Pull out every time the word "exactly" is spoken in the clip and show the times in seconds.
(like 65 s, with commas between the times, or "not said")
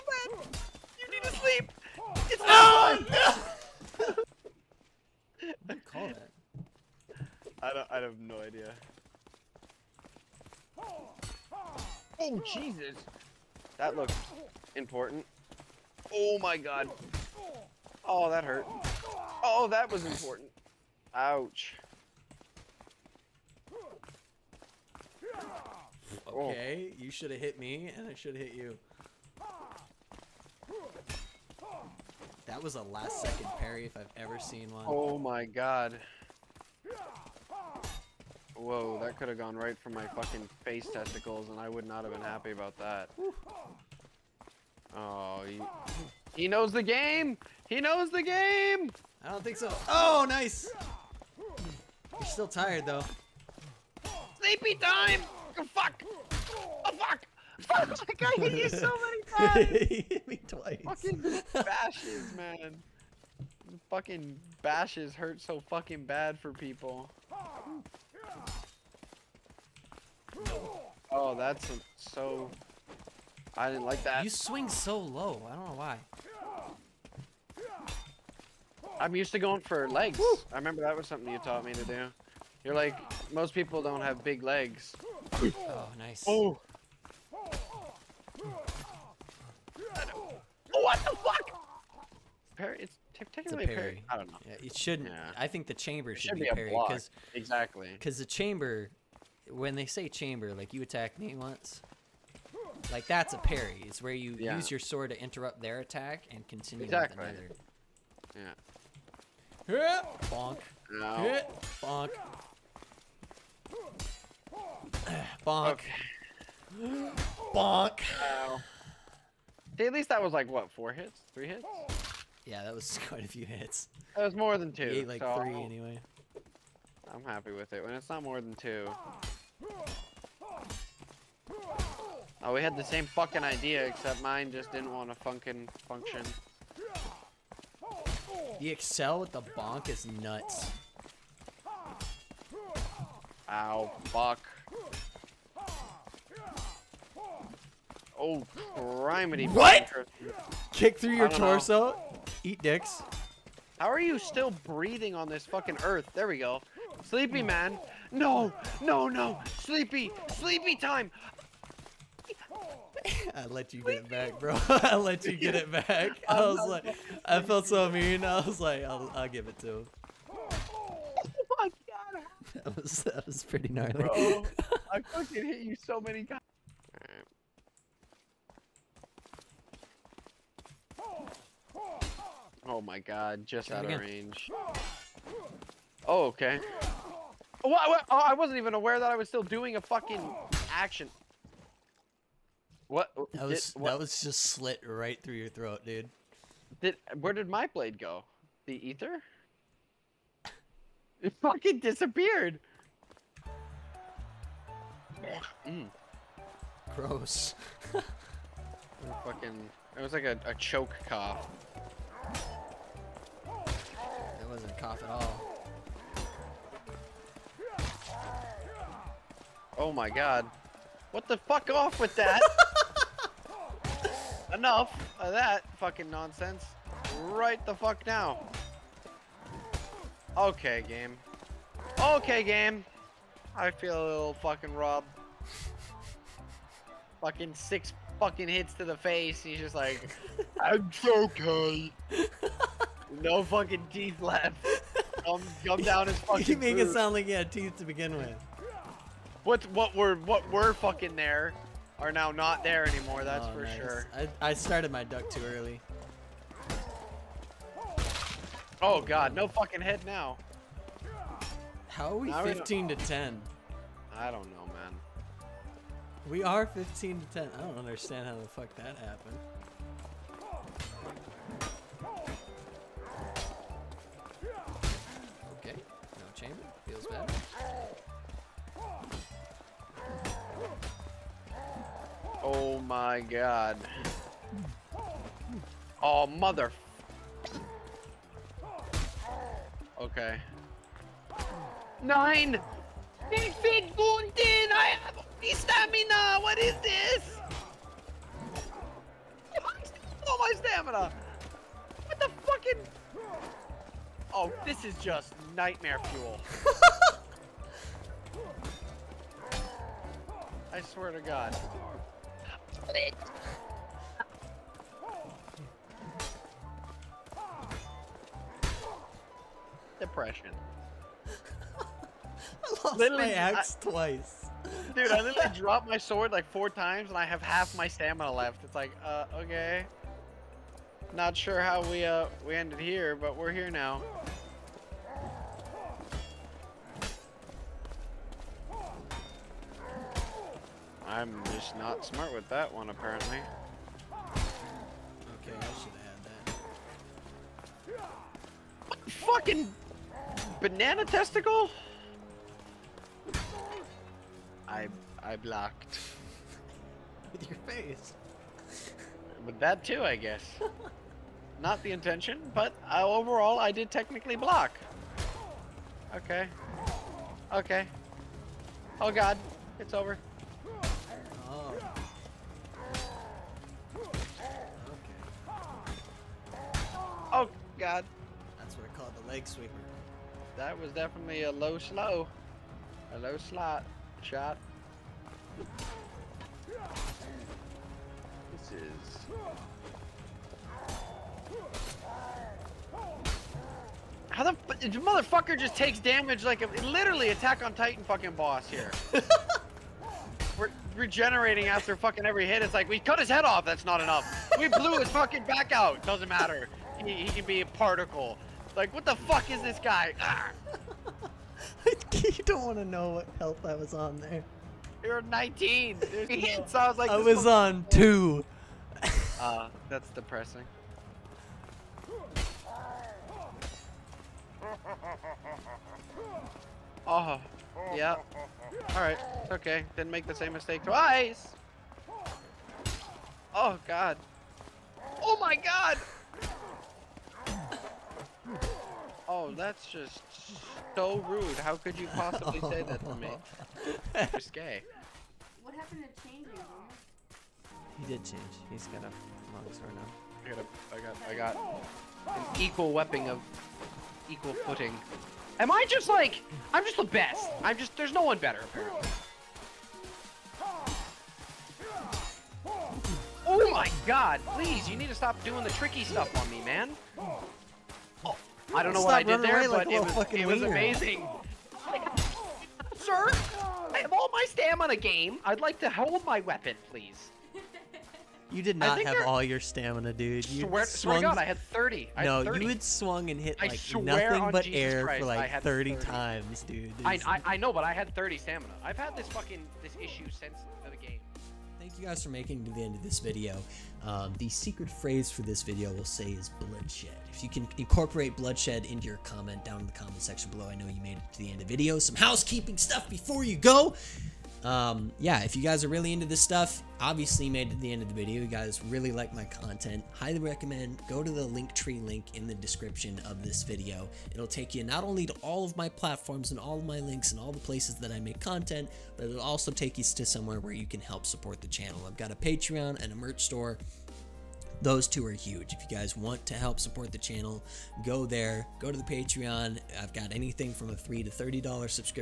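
97 s, 106 s.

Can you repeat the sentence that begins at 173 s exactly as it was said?
Bro, I fucking hit you so many times.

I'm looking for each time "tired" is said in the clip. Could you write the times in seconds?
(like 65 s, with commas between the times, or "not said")
52 s.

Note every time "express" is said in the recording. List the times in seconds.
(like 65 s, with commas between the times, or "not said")
not said.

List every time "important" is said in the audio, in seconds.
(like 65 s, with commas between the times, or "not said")
14 s, 20 s.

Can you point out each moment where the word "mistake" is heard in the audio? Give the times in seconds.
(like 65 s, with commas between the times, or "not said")
430 s.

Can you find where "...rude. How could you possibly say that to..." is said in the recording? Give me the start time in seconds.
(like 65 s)
441 s.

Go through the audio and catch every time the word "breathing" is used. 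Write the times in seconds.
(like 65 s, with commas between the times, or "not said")
154 s.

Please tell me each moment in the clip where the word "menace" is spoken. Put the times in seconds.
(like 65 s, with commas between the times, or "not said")
not said.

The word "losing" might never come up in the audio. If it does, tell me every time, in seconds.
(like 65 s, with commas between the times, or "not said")
not said.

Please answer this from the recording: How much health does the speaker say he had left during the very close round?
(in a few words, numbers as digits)
2.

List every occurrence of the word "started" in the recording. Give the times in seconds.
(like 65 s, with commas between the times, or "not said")
254 s.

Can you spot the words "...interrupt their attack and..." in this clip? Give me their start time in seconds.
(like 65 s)
105 s.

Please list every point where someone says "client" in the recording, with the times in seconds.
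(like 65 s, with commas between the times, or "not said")
not said.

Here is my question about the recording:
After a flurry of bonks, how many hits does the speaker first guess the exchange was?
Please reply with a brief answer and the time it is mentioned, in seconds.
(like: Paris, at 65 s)
4, at 120 s.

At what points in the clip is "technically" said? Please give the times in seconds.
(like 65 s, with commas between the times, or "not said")
93 s, 363 s.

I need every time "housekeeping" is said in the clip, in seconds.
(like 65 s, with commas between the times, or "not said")
502 s.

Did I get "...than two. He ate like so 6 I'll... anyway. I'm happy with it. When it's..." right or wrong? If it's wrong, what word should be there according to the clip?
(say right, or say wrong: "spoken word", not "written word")
wrong: "3", not "6".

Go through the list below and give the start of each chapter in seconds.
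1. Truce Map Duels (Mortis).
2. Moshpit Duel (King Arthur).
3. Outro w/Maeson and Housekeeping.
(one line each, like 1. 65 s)
1. 203 s
2. 443 s
3. 498 s.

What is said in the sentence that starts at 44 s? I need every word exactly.
Oh, he, he knows the game!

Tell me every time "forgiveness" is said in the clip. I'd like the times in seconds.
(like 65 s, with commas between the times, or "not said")
not said.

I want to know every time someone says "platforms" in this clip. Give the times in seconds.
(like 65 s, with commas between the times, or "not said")
515 s.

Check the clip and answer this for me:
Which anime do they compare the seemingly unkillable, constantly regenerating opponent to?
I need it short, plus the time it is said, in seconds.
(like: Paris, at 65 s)
Attack on Titan, at 397 s.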